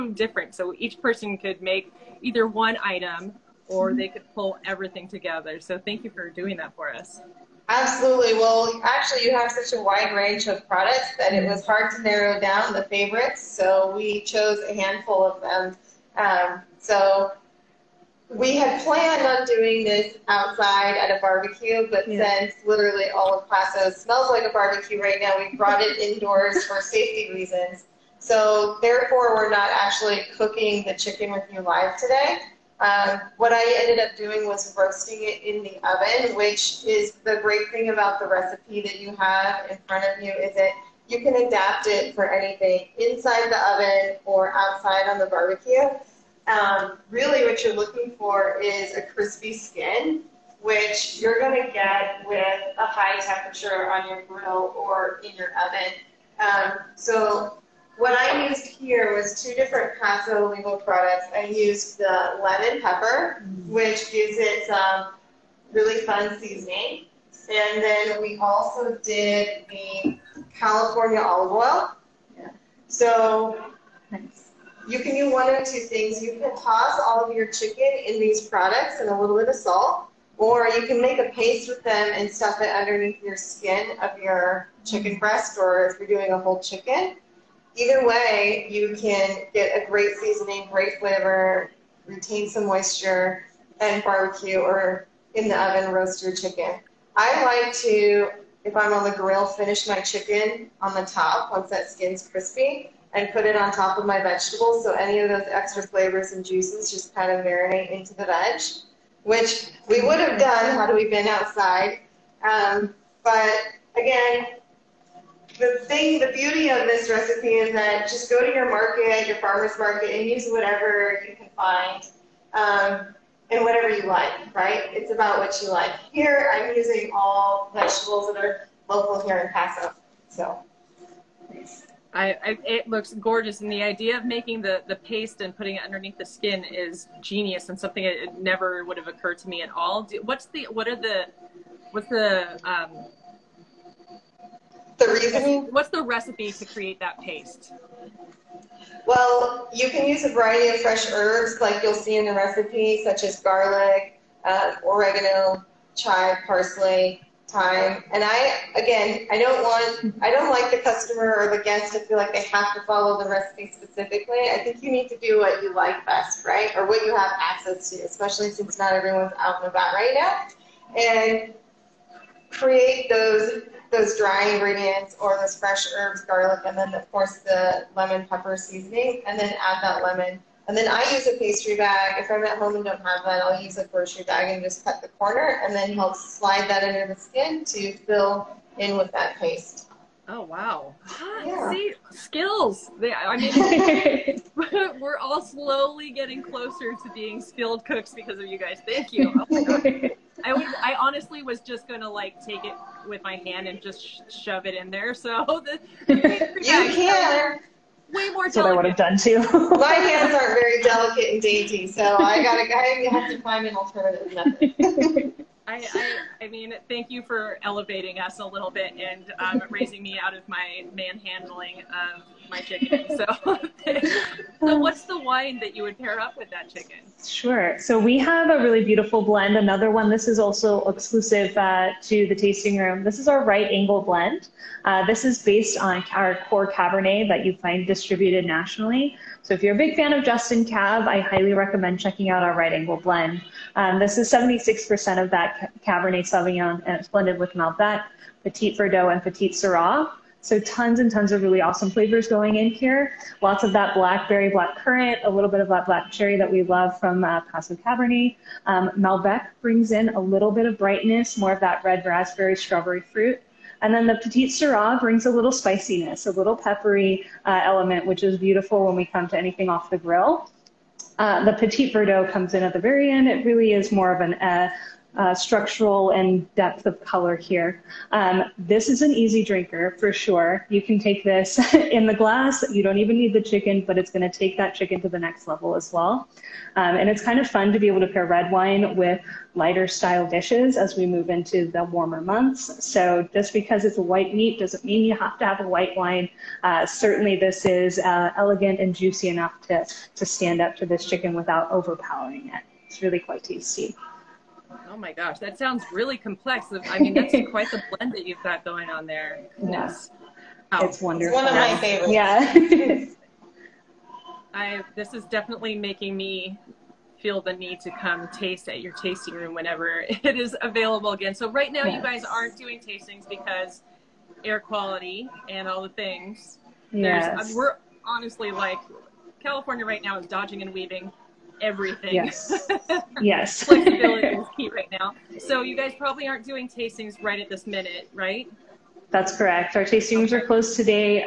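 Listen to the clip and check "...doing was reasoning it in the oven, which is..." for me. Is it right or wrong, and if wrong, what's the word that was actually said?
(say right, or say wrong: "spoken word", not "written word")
wrong: "roasting", not "reasoning".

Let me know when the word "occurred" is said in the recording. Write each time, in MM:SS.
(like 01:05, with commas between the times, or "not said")
02:19.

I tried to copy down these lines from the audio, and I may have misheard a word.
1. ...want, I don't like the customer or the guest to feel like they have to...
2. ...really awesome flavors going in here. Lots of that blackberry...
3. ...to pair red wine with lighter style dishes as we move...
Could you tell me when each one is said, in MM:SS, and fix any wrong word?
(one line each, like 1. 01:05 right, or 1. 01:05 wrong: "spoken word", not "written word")
1. 02:39 right
2. 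04:11 right
3. 04:48 right.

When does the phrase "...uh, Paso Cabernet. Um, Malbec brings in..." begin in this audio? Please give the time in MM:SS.
04:17.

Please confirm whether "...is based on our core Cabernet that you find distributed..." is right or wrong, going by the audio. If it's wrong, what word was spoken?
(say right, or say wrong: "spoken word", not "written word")
right.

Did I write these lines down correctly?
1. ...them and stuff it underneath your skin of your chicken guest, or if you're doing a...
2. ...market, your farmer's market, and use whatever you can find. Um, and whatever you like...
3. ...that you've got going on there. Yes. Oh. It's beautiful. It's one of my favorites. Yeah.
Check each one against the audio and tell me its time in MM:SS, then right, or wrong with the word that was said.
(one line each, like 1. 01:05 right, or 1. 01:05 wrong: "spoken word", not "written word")
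1. 01:21 wrong: "breast", not "guest"
2. 01:58 right
3. 05:08 wrong: "wonderful", not "beautiful".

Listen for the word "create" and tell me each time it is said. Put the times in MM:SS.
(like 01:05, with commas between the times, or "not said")
02:26, 02:52.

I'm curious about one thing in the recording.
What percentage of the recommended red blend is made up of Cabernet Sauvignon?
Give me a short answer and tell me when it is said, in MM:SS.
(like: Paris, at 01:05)
76%, at 04:04.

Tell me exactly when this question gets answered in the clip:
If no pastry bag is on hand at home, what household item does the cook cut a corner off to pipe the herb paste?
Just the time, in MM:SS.
03:03.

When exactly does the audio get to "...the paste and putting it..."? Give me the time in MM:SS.
02:14.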